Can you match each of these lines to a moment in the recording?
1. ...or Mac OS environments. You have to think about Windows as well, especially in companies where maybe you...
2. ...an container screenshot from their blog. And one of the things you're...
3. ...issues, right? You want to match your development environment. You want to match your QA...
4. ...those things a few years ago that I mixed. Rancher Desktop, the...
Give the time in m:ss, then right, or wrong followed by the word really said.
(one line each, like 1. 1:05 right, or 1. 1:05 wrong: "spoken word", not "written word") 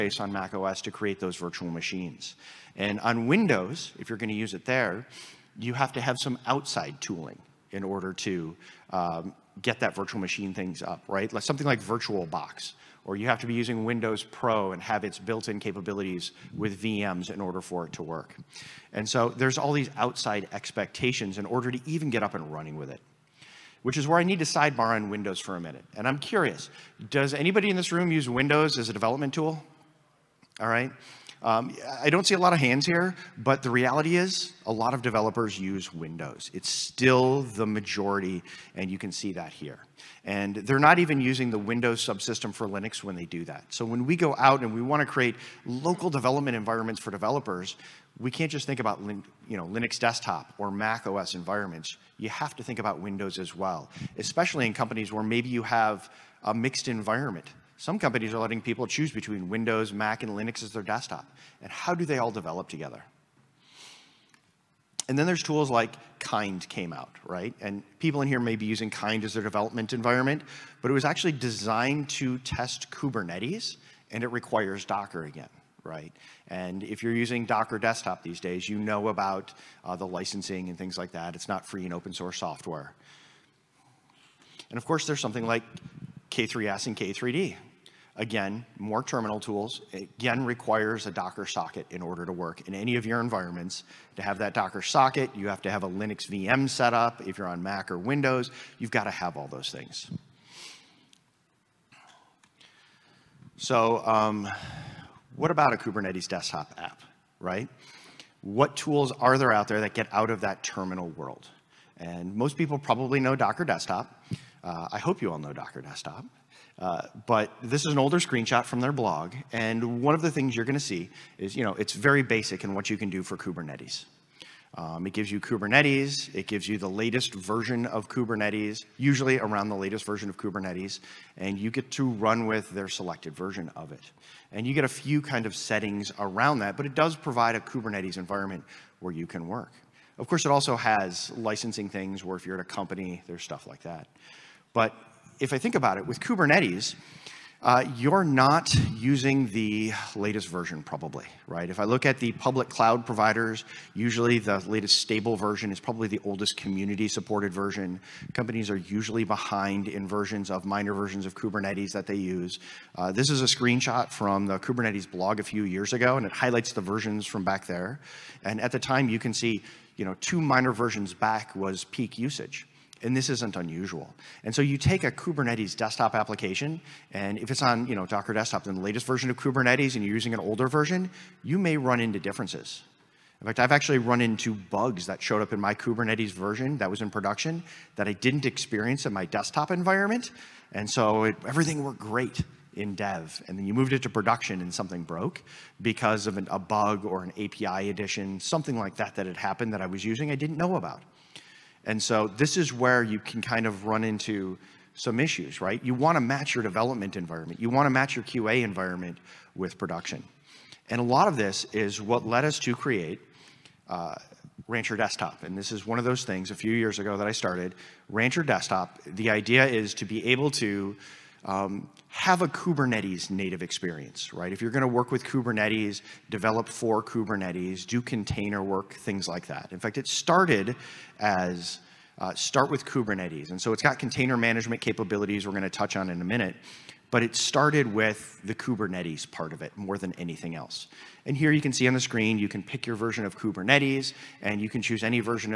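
1. 0:50 right
2. 1:57 wrong: "older", not "container"
3. 3:25 right
4. 3:36 wrong: "started", not "mixed".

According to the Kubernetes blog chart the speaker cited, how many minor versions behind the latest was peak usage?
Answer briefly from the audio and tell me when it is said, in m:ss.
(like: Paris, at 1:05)
2, at 2:50.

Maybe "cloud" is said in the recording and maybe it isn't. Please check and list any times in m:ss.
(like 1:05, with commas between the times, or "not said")
2:32.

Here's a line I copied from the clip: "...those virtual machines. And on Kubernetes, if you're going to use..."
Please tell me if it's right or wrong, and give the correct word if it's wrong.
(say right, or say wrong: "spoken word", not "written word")
wrong: "Windows", not "Kubernetes".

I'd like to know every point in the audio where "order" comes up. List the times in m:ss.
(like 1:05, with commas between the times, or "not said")
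0:07, 0:17, 0:21, 1:32.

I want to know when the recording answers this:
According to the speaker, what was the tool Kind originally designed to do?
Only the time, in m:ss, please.
1:12.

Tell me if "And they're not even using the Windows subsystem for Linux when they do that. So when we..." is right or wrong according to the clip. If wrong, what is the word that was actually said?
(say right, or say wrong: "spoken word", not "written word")
right.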